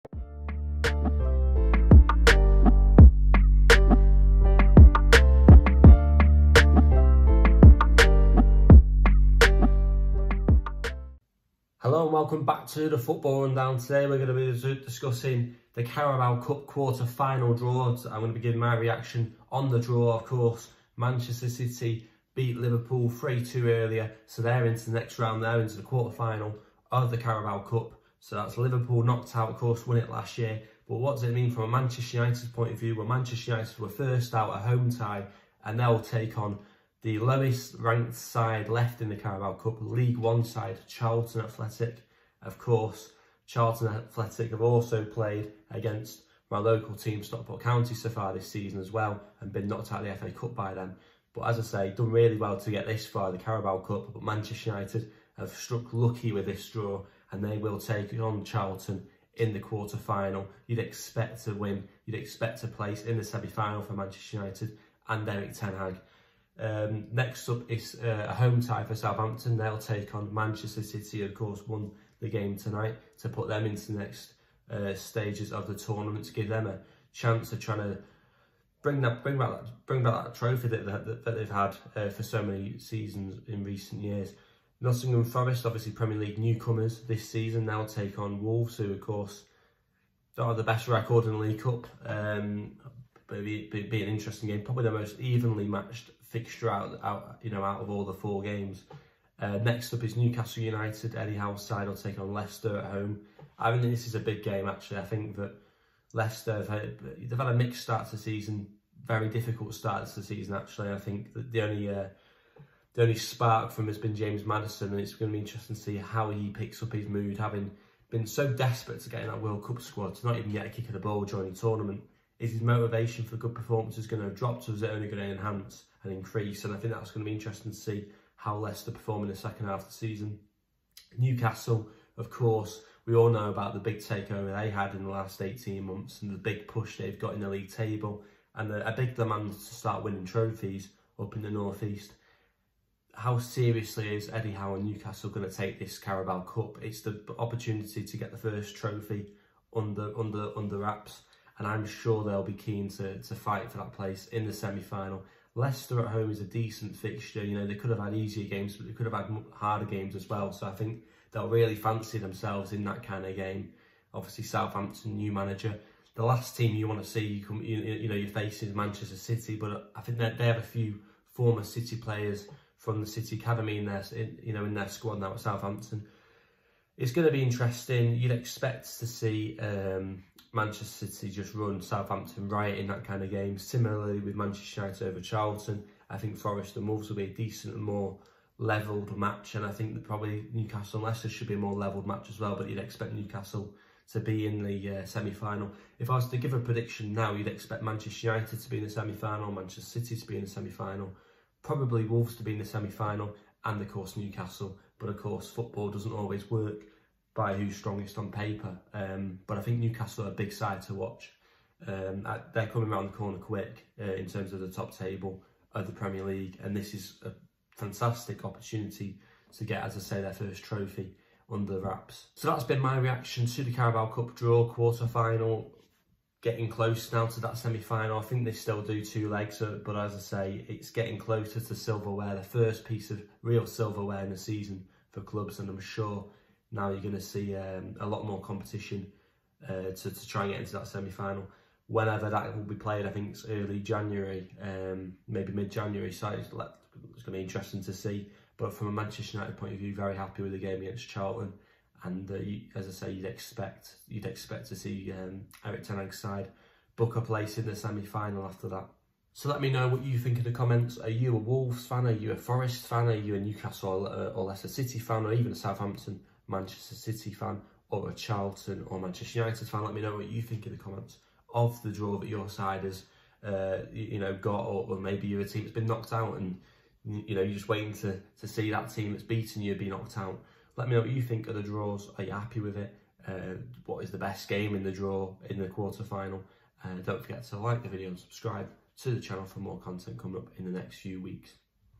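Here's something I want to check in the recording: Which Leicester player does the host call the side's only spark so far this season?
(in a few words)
James Maddison.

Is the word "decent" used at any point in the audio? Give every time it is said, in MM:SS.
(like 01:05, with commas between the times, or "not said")
02:36, 03:07.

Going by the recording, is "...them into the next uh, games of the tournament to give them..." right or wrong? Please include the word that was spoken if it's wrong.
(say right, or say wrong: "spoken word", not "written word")
wrong: "stages", not "games".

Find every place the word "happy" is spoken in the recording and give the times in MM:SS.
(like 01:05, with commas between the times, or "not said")
04:10, 04:42.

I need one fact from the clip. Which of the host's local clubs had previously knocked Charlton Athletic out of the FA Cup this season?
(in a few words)
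Stockport County.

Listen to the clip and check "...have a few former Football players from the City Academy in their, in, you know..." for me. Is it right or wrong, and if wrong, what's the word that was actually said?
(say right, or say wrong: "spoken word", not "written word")
wrong: "City", not "Football".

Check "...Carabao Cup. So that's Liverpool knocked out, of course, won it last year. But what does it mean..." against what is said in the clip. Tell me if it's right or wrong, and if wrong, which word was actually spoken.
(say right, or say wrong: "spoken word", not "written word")
right.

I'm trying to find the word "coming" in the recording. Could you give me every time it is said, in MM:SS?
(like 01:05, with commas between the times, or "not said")
03:32, 04:50.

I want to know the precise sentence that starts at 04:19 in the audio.
So let me know what you think in the comments.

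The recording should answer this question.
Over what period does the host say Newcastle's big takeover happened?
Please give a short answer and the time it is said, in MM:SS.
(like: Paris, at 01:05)
18 months, at 02:15.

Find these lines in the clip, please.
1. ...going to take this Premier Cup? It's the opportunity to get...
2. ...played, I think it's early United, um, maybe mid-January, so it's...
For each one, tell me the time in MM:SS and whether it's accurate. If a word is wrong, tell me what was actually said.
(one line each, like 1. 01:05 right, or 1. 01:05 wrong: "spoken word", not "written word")
1. 02:25 wrong: "Carabao", not "Premier"
2. 04:02 wrong: "January", not "United".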